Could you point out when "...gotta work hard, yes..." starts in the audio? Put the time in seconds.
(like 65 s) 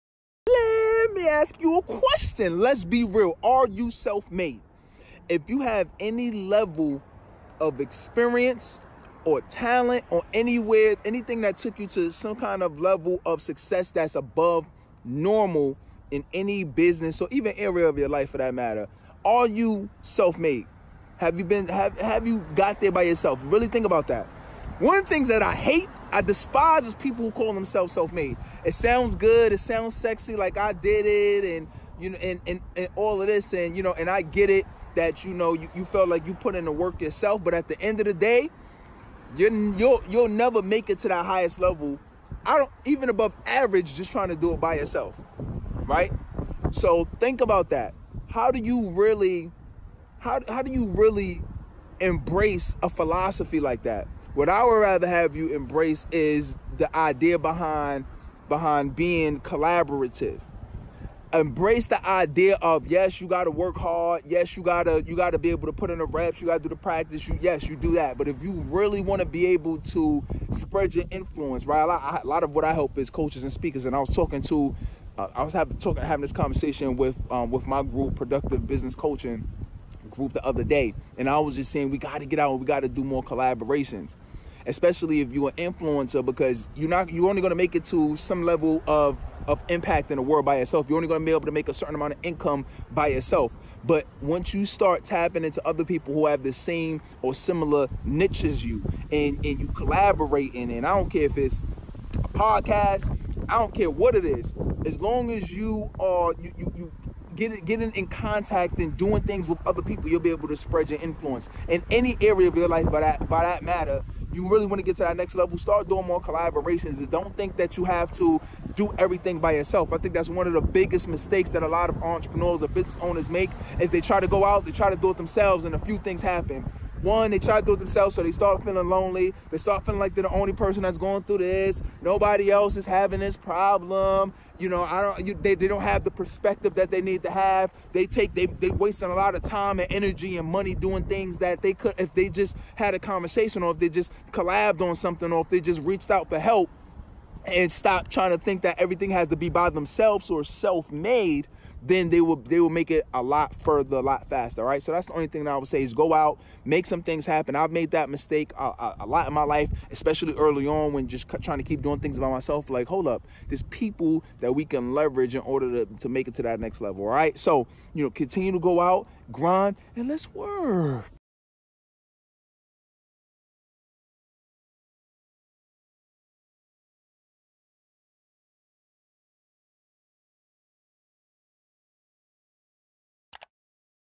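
63 s.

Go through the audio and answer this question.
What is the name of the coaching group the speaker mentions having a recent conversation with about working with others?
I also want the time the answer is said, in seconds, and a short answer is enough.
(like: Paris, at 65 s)
productive business coaching group, at 78 s.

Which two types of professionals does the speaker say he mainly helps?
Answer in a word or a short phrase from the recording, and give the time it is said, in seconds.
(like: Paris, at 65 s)
coaches and speakers, at 73 s.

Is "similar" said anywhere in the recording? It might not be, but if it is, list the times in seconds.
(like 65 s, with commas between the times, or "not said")
97 s.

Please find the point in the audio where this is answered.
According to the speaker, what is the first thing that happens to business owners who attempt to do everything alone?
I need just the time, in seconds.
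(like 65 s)
128 s.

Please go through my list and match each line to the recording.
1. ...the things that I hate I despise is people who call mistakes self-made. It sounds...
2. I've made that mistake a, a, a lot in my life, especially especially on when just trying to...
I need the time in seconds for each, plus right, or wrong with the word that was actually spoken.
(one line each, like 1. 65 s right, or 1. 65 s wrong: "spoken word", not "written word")
1. 25 s wrong: "themselves", not "mistakes"
2. 157 s wrong: "early", not "especially".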